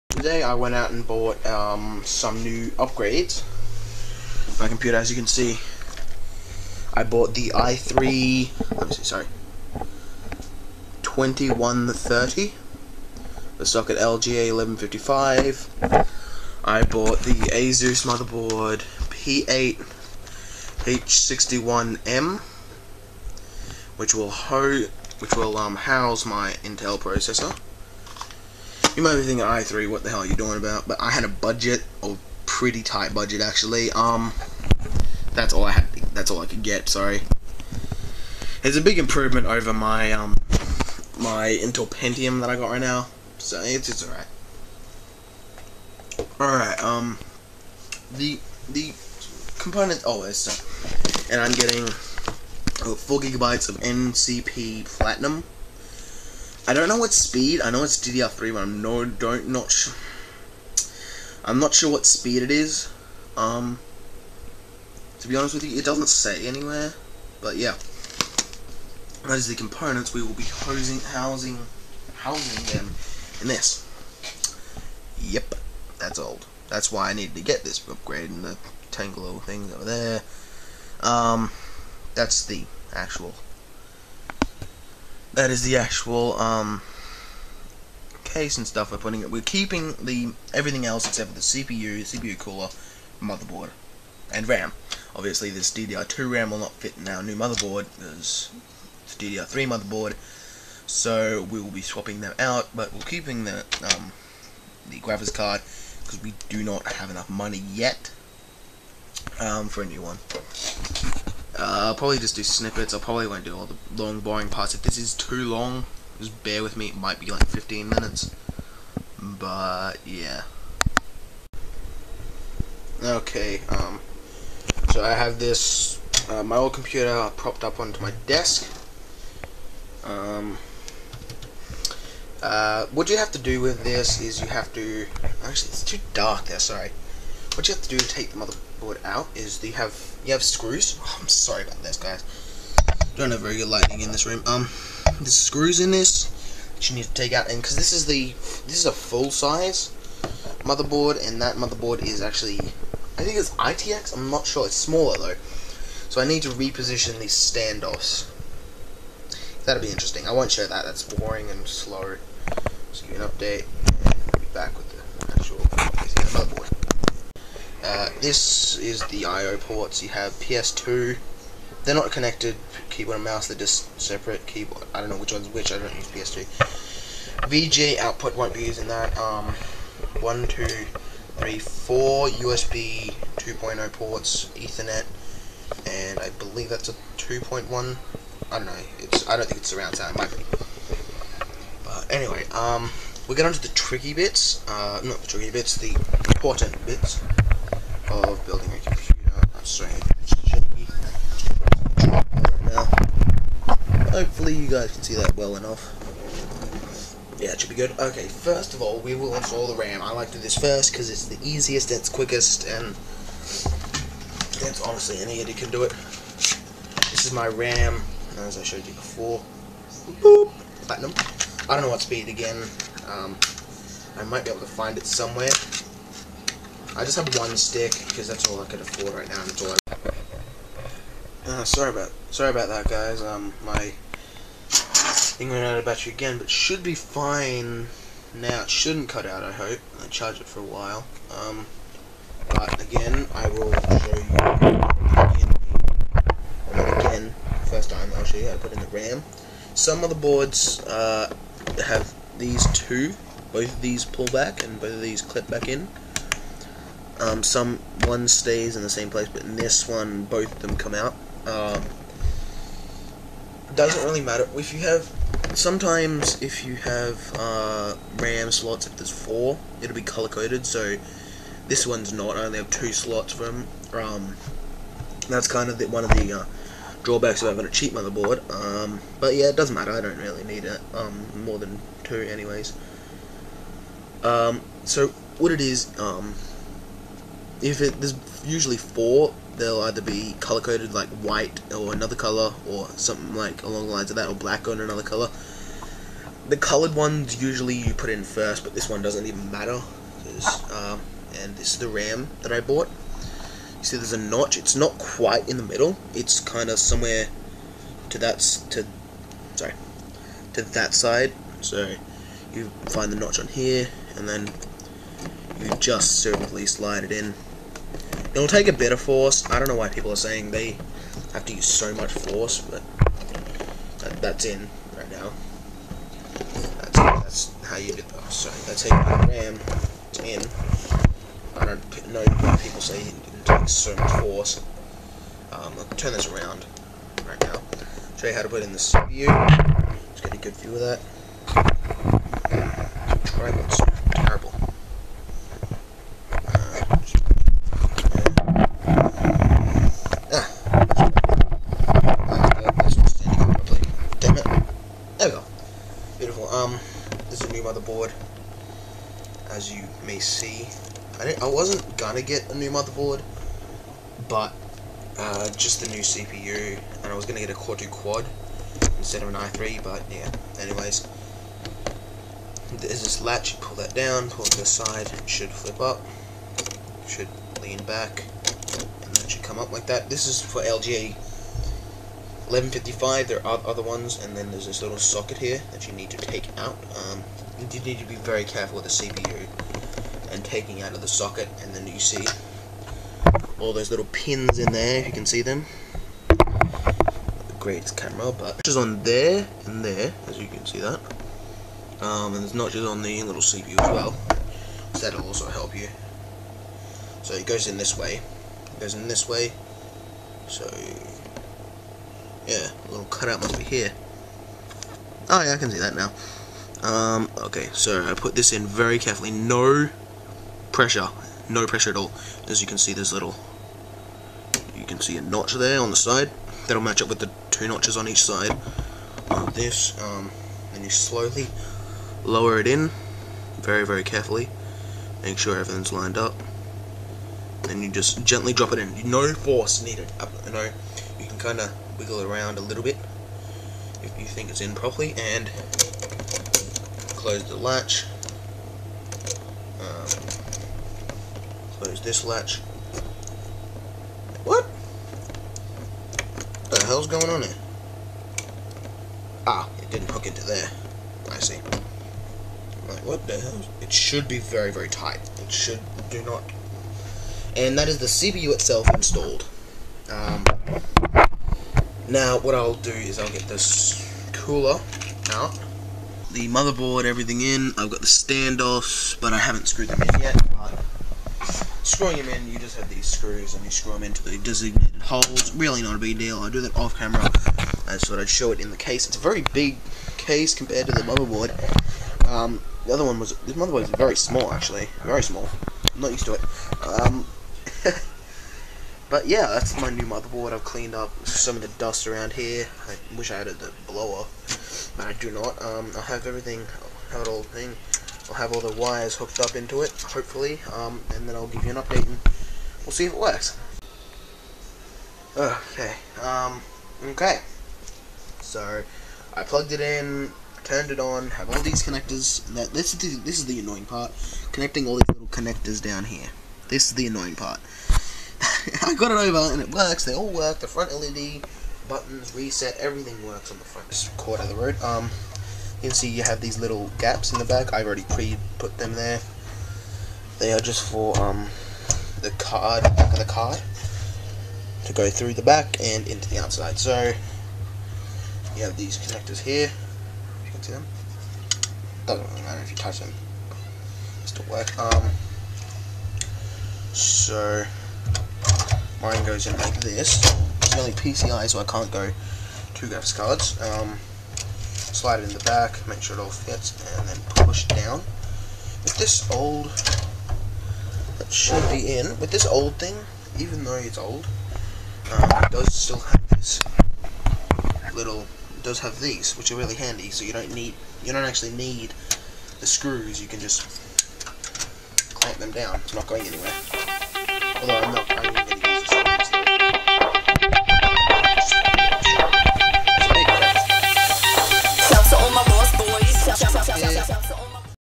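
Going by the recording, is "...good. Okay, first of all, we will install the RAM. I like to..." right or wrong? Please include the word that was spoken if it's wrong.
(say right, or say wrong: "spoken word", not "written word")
right.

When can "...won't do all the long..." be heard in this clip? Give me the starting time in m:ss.
1:53.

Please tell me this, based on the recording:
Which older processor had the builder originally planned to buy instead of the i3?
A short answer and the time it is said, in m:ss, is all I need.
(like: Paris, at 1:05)
Core 2 Quad, at 6:07.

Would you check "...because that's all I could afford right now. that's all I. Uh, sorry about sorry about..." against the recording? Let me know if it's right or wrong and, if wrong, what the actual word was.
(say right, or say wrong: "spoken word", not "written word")
right.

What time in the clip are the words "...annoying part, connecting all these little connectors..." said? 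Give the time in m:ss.
8:43.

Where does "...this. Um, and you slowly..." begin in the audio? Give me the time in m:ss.
7:09.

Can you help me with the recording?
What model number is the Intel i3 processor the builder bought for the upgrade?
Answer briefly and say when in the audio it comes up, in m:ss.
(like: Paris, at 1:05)
2130, at 0:11.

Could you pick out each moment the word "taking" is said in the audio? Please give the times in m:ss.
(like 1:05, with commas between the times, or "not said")
6:30.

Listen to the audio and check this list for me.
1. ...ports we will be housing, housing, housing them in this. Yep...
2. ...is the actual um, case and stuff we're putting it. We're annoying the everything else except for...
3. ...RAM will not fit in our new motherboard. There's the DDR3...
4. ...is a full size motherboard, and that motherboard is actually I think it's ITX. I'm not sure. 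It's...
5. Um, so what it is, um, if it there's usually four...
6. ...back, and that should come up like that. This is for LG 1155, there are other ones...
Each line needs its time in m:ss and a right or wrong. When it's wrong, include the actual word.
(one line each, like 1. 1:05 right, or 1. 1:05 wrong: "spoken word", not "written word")
1. 1:09 wrong: "components", not "ports"
2. 1:25 wrong: "keeping", not "annoying"
3. 1:36 right
4. 2:28 right
5. 4:44 right
6. 6:17 right.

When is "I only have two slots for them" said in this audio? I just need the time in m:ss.
4:32.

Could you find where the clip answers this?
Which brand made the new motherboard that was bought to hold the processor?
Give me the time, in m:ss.
0:17.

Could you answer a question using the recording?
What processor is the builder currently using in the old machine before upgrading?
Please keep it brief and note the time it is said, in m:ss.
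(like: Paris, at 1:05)
Intel Pentium, at 0:41.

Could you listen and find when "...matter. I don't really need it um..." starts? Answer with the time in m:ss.
4:39.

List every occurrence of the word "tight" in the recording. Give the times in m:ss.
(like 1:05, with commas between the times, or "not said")
0:32, 7:44.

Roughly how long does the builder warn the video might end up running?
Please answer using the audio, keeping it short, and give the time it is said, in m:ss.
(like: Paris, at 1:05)
15 minutes, at 1:57.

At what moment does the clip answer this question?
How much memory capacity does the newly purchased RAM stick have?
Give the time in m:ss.
0:52.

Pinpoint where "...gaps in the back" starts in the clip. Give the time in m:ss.
8:56.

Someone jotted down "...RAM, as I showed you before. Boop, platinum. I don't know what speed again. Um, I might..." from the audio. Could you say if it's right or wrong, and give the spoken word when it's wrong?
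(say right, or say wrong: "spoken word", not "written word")
right.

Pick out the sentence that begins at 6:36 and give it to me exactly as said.
The great camera, but just on there and there, as you can see that.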